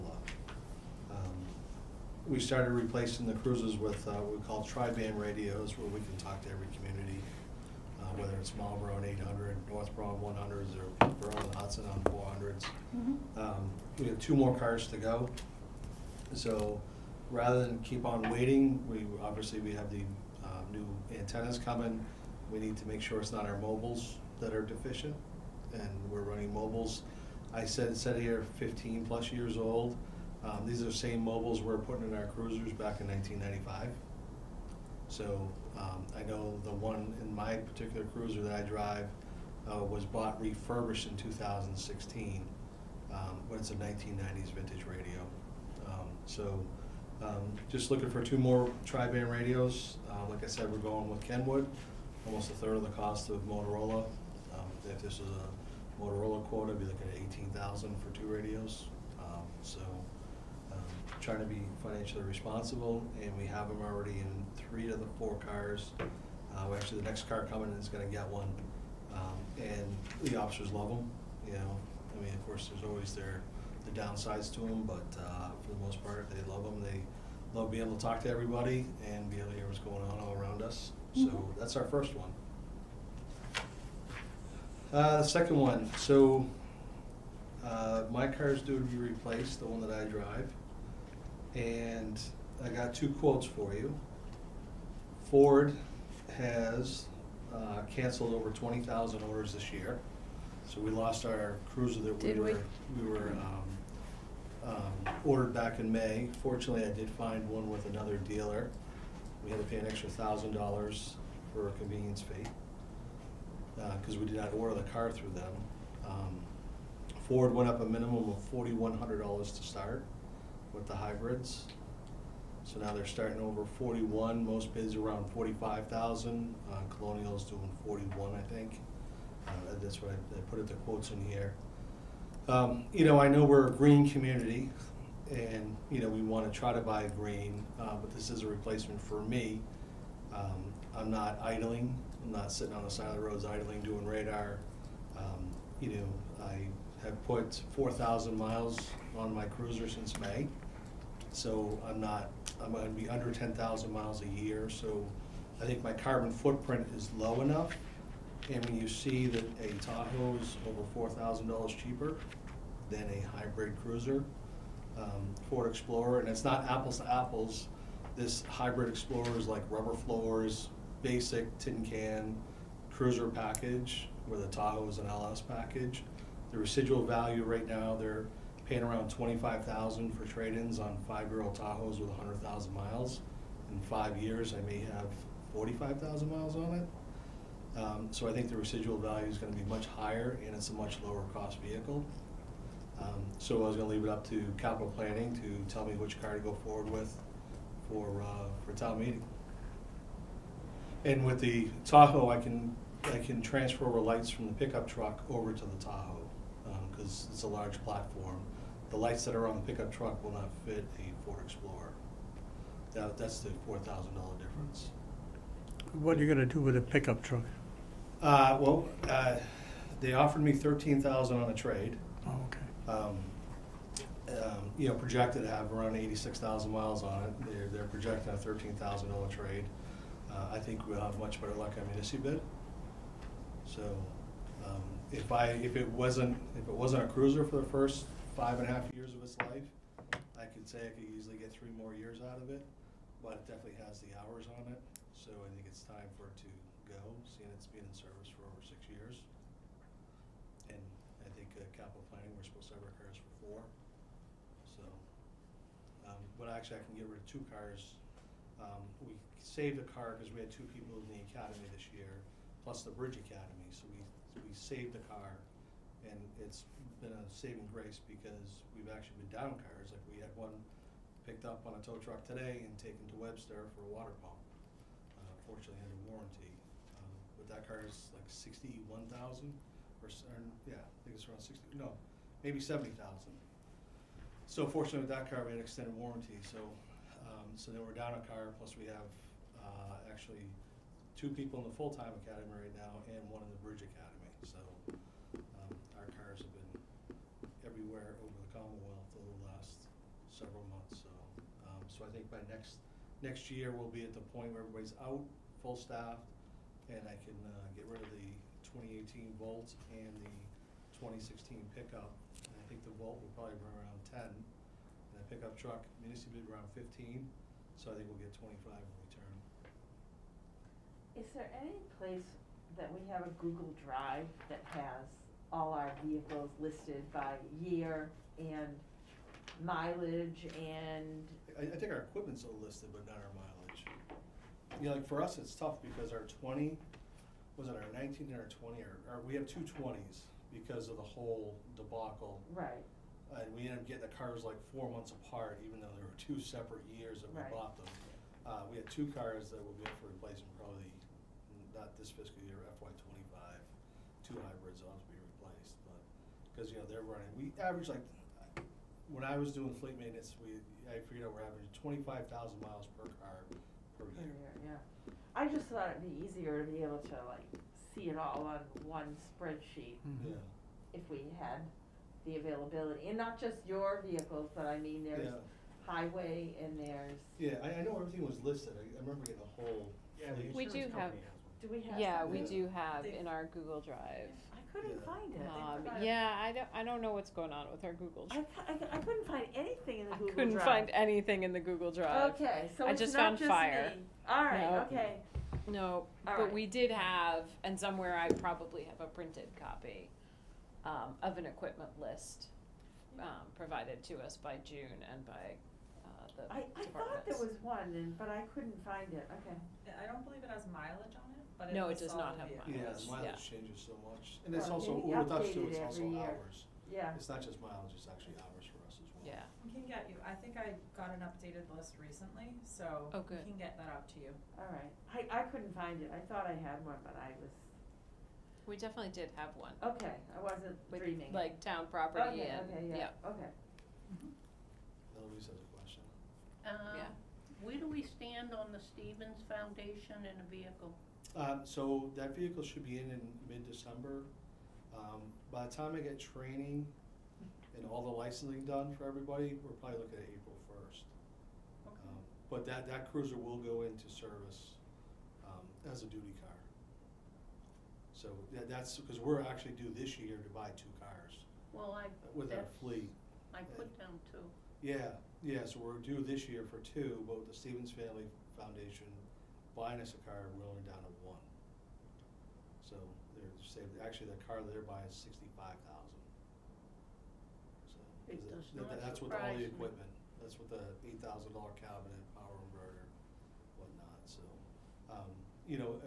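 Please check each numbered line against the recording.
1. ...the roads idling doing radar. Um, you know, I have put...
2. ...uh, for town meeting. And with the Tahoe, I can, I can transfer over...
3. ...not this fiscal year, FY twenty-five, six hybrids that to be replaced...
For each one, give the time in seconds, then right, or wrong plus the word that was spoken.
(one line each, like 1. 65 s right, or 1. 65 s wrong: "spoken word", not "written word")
1. 143 s right
2. 198 s right
3. 351 s wrong: "two", not "six".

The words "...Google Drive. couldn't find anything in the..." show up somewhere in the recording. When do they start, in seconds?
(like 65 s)
390 s.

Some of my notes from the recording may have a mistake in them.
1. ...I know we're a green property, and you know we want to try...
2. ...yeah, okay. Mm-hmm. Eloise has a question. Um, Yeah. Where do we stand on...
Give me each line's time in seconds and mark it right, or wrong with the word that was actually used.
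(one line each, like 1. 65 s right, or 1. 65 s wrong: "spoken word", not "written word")
1. 133 s wrong: "community", not "property"
2. 433 s right.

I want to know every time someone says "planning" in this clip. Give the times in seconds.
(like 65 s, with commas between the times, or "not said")
194 s, 252 s.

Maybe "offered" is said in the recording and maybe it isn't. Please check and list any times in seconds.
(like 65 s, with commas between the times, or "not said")
220 s.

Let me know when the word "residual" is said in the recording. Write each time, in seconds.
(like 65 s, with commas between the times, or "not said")
176 s, 188 s.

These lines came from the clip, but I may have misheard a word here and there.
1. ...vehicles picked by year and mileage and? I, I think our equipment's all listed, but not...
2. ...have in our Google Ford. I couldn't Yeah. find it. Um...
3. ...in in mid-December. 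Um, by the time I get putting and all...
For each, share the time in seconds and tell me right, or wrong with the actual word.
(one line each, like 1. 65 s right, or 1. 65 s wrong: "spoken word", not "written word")
1. 326 s wrong: "listed", not "picked"
2. 382 s wrong: "Drive", not "Ford"
3. 442 s wrong: "training", not "putting".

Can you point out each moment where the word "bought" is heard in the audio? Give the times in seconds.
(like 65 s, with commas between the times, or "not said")
40 s, 347 s.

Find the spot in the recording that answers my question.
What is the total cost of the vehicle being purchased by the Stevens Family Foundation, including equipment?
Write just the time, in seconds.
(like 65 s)
475 s.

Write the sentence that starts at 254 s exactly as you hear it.
So, um, but actually I can get rid of two cars.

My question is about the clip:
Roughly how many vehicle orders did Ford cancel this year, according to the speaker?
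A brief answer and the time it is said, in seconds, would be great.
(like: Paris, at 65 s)
over 20,000, at 98 s.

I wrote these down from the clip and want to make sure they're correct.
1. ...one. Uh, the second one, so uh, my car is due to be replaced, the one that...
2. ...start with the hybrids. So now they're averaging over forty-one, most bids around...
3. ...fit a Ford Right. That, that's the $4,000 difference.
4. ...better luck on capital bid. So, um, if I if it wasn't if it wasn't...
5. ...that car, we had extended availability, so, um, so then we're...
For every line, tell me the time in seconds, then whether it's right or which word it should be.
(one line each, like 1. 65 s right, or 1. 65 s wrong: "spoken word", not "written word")
1. 82 s right
2. 119 s wrong: "starting", not "averaging"
3. 210 s wrong: "Explorer", not "Right"
4. 231 s wrong: "municipal", not "capital"
5. 285 s wrong: "warranty", not "availability".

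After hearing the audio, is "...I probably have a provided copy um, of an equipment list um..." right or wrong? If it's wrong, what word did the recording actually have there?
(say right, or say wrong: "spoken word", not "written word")
wrong: "printed", not "provided".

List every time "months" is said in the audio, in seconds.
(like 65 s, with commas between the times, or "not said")
300 s, 344 s.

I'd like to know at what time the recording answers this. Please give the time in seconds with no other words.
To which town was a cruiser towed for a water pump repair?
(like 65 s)
273 s.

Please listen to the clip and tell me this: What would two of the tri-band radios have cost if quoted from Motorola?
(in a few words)
$18,000.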